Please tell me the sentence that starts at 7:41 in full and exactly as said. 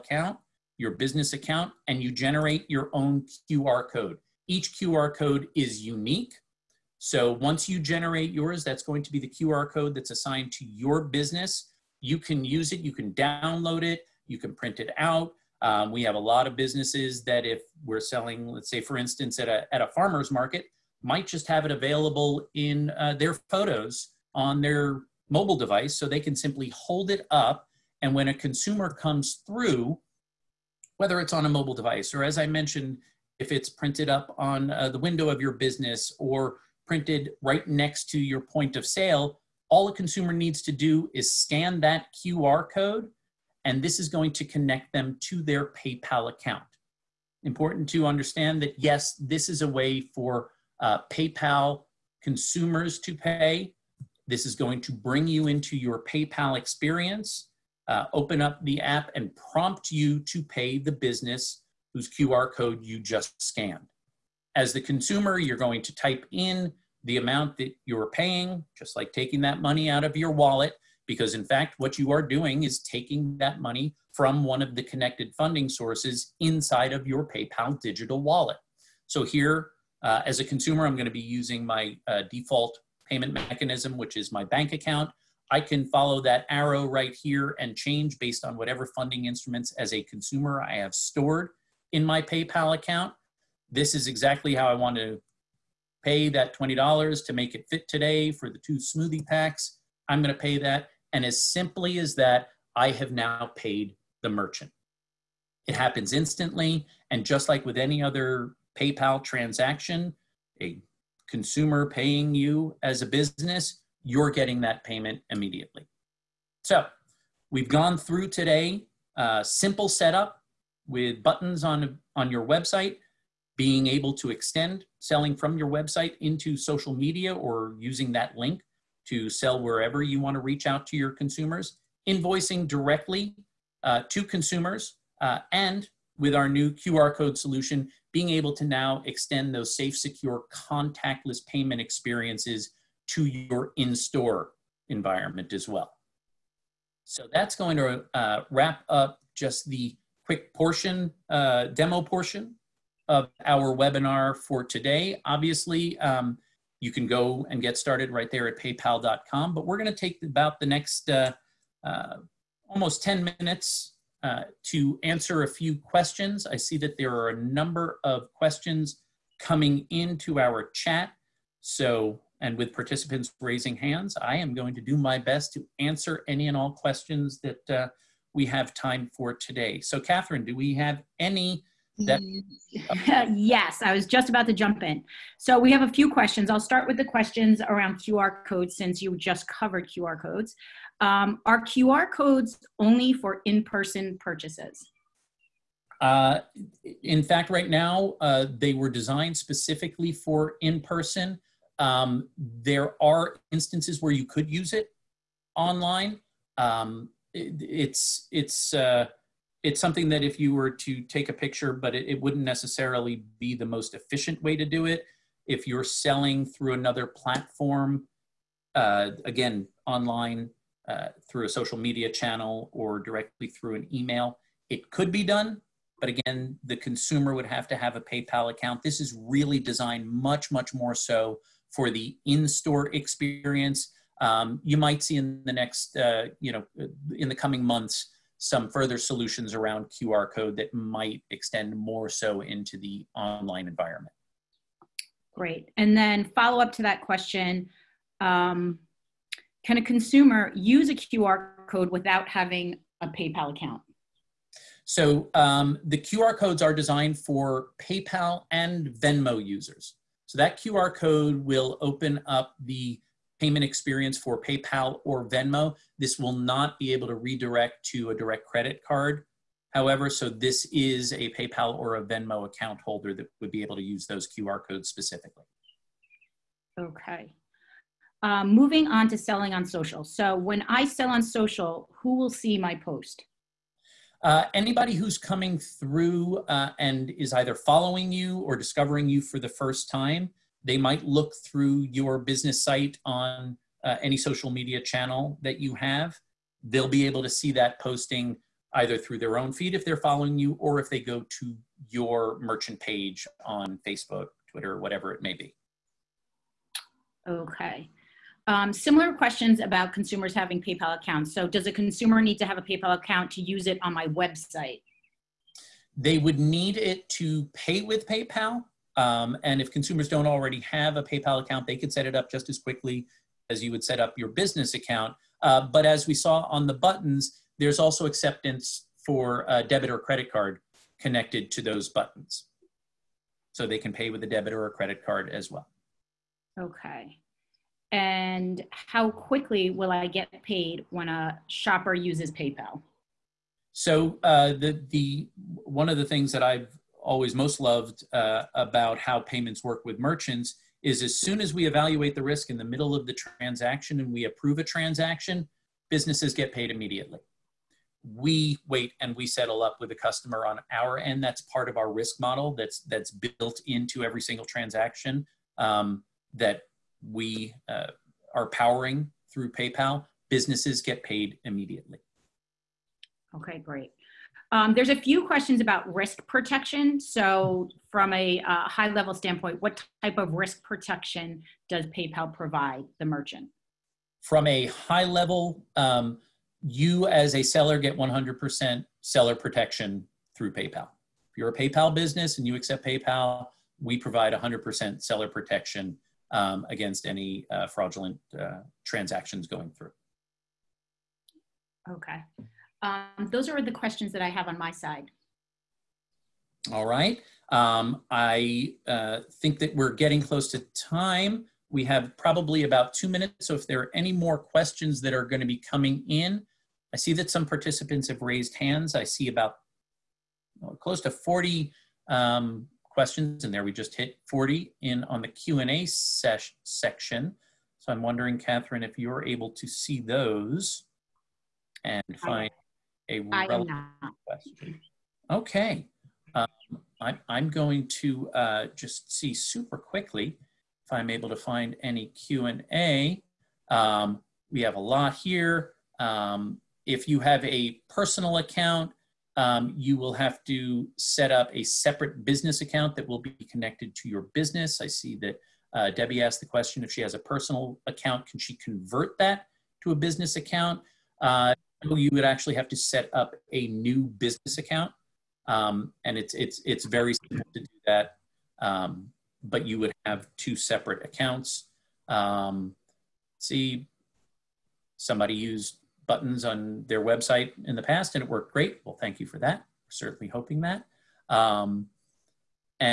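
Uh, you would actually have to set up a new business account, um, and it's it's it's very simple to do that.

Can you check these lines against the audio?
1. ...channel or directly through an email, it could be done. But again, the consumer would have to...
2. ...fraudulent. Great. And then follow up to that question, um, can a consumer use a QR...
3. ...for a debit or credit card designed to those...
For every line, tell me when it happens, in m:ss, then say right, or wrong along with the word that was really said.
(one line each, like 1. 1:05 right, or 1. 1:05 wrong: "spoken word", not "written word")
1. 3:42 right
2. 4:03 wrong: "environment", not "fraudulent"
3. 5:29 wrong: "connected", not "designed".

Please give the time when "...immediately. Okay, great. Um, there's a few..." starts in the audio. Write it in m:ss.
6:11.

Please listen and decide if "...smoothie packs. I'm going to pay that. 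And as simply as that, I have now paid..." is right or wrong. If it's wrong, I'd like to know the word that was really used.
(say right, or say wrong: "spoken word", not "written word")
right.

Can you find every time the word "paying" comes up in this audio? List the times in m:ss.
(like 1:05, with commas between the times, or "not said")
1:08, 1:51.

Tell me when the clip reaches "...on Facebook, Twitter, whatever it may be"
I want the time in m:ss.
5:03.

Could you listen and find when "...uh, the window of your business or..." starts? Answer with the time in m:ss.
0:34.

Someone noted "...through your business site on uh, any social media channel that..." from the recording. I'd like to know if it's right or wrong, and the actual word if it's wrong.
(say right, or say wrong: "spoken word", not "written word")
right.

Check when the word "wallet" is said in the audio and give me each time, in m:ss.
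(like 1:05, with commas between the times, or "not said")
1:10, 1:18.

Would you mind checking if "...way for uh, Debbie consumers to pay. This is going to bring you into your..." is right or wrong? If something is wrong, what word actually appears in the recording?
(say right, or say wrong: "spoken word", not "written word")
wrong: "PayPal", not "Debbie".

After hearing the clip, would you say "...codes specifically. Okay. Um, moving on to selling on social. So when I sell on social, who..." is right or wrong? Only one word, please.
right.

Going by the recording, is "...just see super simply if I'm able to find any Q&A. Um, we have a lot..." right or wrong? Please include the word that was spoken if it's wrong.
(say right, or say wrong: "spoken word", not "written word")
wrong: "quickly", not "simply".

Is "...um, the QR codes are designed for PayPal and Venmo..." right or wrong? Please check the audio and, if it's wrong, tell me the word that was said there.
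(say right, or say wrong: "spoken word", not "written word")
right.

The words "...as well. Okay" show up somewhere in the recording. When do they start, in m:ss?
5:35.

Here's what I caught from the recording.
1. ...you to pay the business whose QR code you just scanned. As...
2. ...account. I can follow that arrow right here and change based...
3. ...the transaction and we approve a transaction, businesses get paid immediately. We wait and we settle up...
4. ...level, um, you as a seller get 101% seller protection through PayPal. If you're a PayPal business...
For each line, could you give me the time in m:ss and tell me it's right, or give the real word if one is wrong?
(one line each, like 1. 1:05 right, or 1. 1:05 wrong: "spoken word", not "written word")
1. 0:59 right
2. 1:24 right
3. 5:53 right
4. 6:25 wrong: "100", not "101".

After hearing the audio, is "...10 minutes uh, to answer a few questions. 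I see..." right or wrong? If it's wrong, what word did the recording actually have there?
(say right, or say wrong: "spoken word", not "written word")
right.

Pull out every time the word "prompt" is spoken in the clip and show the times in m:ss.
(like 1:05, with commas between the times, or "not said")
0:59.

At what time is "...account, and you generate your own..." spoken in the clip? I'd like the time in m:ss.
0:01.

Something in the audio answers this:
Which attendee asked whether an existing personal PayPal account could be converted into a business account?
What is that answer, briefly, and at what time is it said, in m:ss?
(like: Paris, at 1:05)
Debbie, at 7:35.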